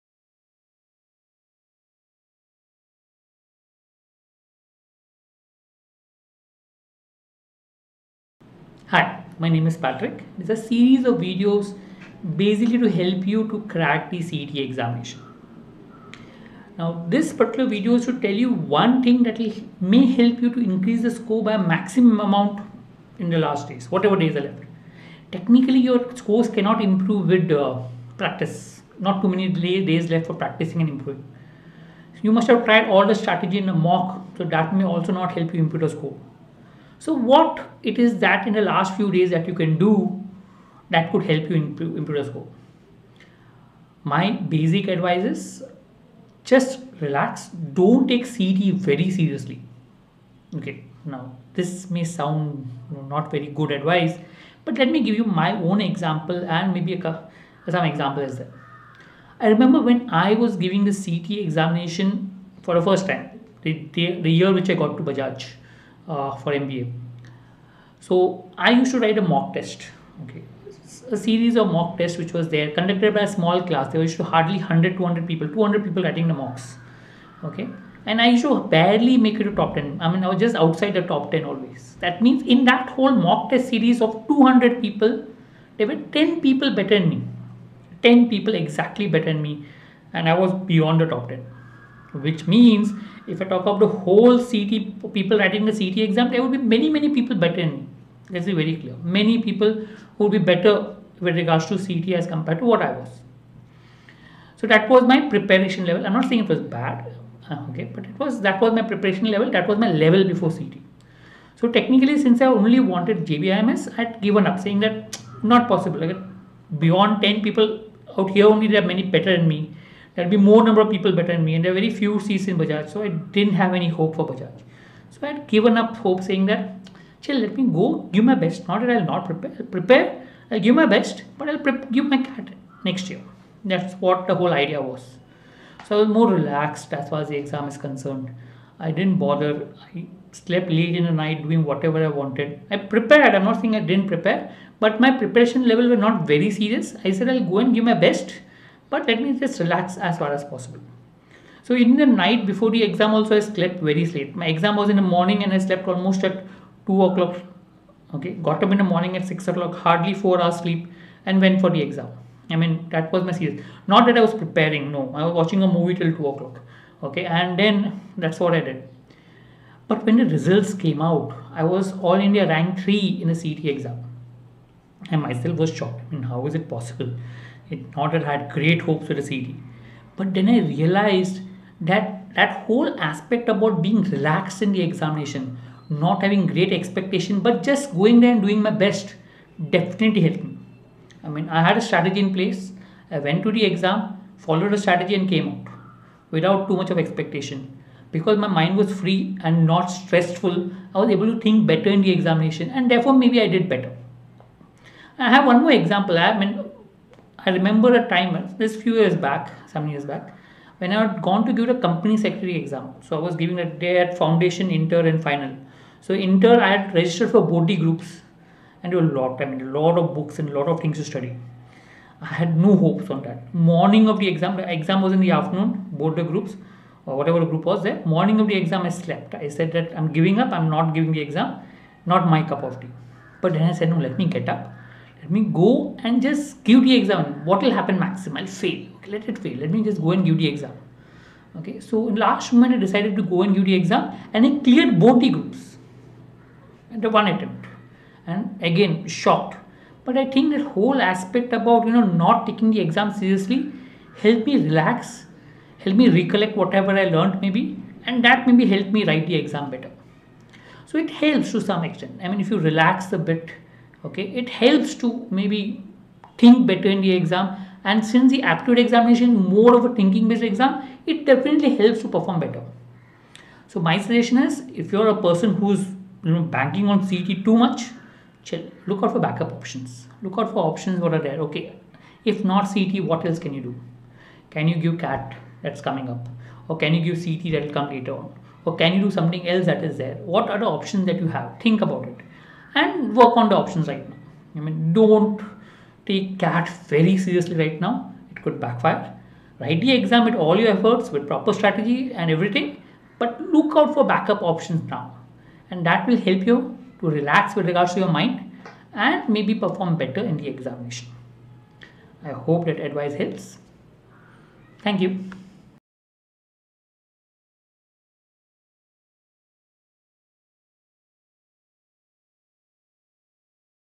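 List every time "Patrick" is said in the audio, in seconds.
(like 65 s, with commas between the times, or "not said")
9 s.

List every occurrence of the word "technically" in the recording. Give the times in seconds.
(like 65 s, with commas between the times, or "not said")
25 s, 111 s.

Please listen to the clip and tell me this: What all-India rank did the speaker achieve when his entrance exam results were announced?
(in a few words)
3.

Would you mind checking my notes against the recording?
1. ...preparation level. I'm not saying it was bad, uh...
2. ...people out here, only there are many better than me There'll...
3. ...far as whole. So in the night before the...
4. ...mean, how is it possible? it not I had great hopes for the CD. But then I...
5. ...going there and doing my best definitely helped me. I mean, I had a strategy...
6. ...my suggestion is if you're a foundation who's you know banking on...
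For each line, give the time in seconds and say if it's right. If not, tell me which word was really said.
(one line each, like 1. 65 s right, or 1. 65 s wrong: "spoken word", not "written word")
1. 105 s right
2. 117 s right
3. 150 s wrong: "possible", not "whole"
4. 176 s right
5. 187 s right
6. 273 s wrong: "person", not "foundation".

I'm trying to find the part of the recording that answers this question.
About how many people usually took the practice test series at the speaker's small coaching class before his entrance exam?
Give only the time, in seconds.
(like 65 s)
75 s.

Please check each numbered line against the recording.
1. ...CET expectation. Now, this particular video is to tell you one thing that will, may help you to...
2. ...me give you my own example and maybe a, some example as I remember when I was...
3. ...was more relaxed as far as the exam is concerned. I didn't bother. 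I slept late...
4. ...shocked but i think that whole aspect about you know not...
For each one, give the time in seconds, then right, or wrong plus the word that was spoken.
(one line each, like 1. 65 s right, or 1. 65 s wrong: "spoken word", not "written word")
1. 14 s wrong: "examination", not "expectation"
2. 54 s right
3. 136 s right
4. 249 s right.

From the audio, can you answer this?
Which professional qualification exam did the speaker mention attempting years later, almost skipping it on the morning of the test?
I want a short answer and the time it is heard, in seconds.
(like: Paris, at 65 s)
Company secretary, at 211 s.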